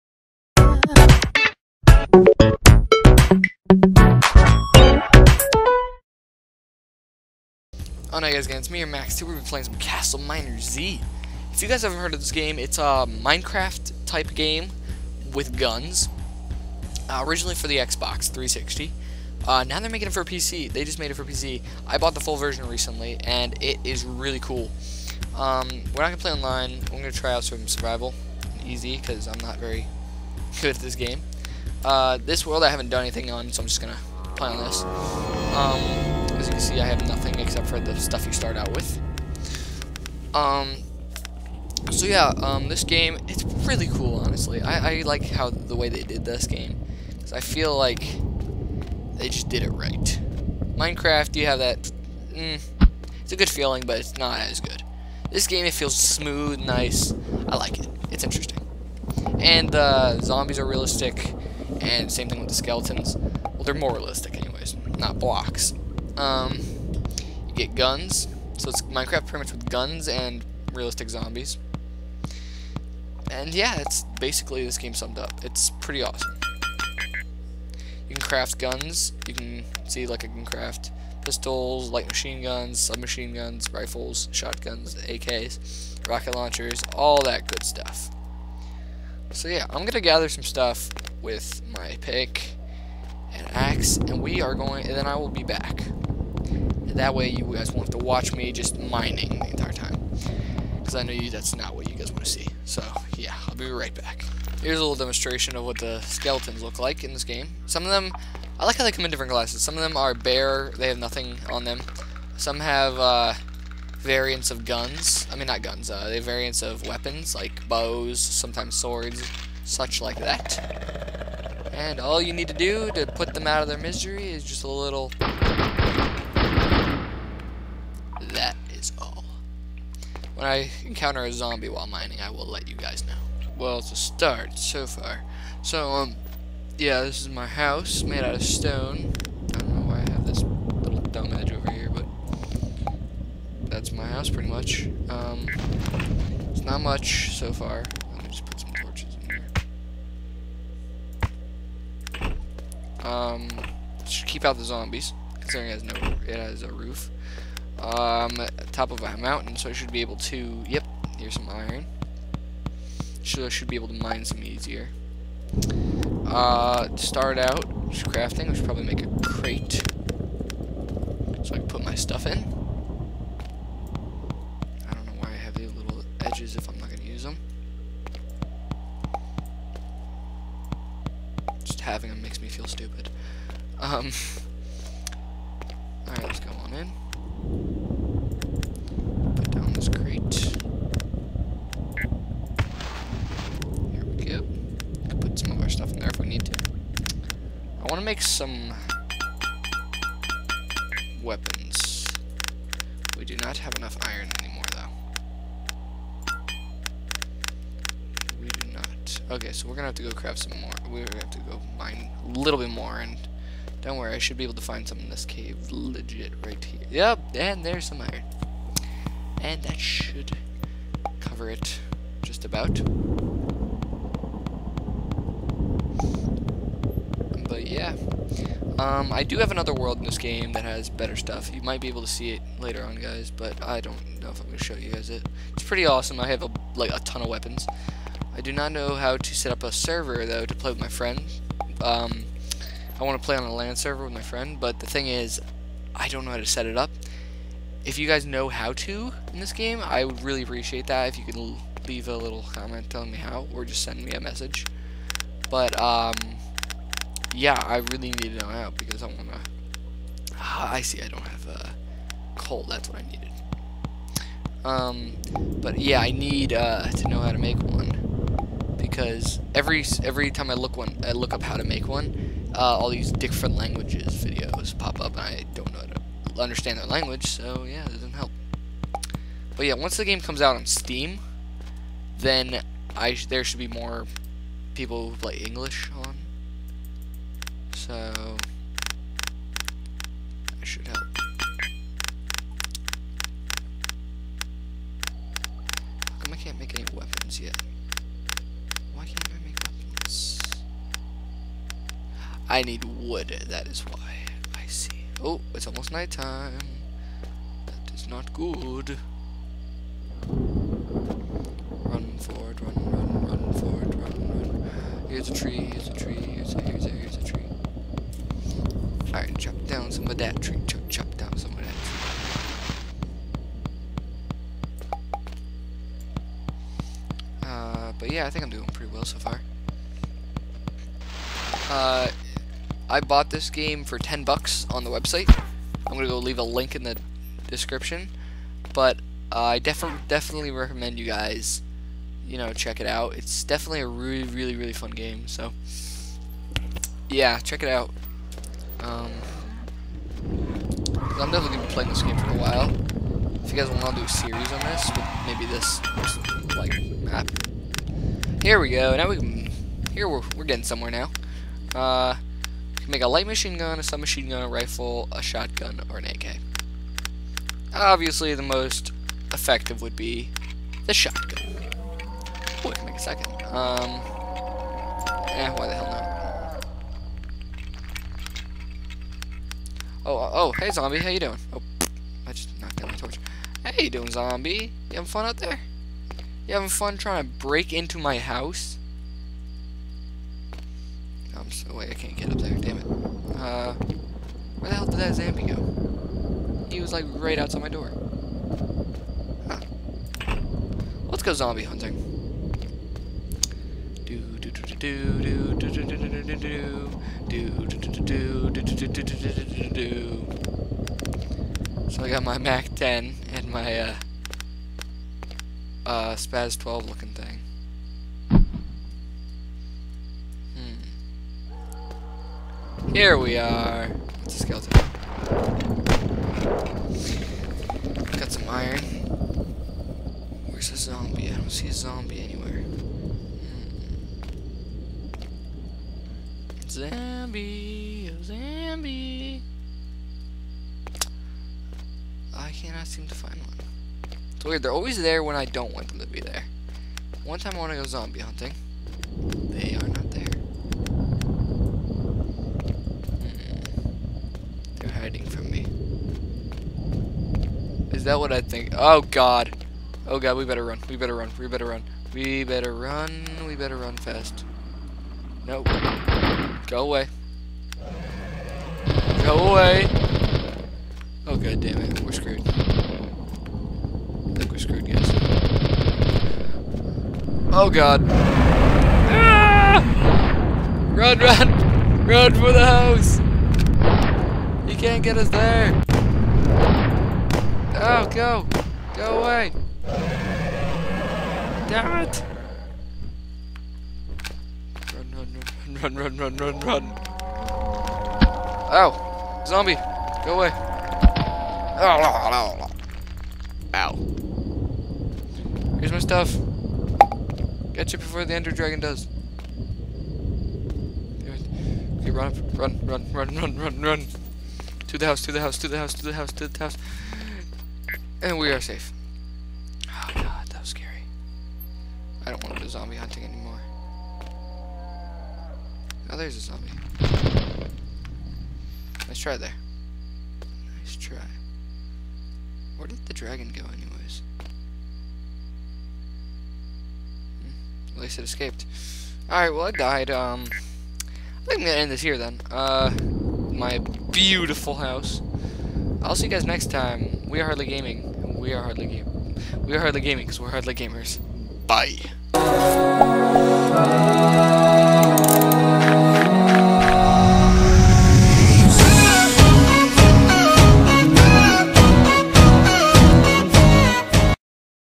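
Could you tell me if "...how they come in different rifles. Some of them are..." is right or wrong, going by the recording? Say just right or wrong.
wrong.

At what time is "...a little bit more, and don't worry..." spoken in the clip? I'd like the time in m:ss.
3:32.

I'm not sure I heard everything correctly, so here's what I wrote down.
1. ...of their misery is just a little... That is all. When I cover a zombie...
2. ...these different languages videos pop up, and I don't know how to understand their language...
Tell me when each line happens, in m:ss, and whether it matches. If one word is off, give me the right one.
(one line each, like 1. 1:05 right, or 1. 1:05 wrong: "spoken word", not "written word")
1. 2:03 wrong: "encounter", not "cover"
2. 4:32 right.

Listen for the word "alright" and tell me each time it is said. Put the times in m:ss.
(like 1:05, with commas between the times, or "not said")
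3:06, 5:19, 8:59.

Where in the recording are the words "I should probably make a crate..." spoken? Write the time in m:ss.
2:48.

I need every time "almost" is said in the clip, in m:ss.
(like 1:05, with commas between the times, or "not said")
5:05.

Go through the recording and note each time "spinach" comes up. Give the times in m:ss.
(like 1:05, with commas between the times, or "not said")
not said.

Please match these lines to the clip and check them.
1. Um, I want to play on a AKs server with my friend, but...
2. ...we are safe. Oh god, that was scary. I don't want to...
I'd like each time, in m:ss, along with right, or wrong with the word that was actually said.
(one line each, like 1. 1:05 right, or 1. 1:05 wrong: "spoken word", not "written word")
1. 4:01 wrong: "LAN", not "AKs"
2. 8:38 right.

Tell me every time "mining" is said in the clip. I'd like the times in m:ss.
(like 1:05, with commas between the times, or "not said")
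1:38, 2:11.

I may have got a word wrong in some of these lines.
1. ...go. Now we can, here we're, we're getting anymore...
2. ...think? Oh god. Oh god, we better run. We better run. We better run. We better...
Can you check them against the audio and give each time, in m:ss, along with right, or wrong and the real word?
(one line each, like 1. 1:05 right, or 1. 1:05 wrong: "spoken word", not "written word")
1. 5:58 wrong: "somewhere", not "anymore"
2. 7:38 right.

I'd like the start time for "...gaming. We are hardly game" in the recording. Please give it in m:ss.
9:07.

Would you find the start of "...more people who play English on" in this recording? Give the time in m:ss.
4:43.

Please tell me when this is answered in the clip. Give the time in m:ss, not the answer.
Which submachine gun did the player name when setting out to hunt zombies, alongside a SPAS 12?
6:52.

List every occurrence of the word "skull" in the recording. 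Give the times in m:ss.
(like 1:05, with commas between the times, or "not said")
not said.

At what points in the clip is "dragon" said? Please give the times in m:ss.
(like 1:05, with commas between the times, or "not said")
8:28, 8:53.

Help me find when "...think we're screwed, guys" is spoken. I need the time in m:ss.
7:54.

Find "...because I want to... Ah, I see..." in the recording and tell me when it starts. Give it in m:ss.
4:18.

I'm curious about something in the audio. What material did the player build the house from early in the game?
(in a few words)
stone.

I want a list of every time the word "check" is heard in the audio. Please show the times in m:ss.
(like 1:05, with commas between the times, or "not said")
5:42, 5:47.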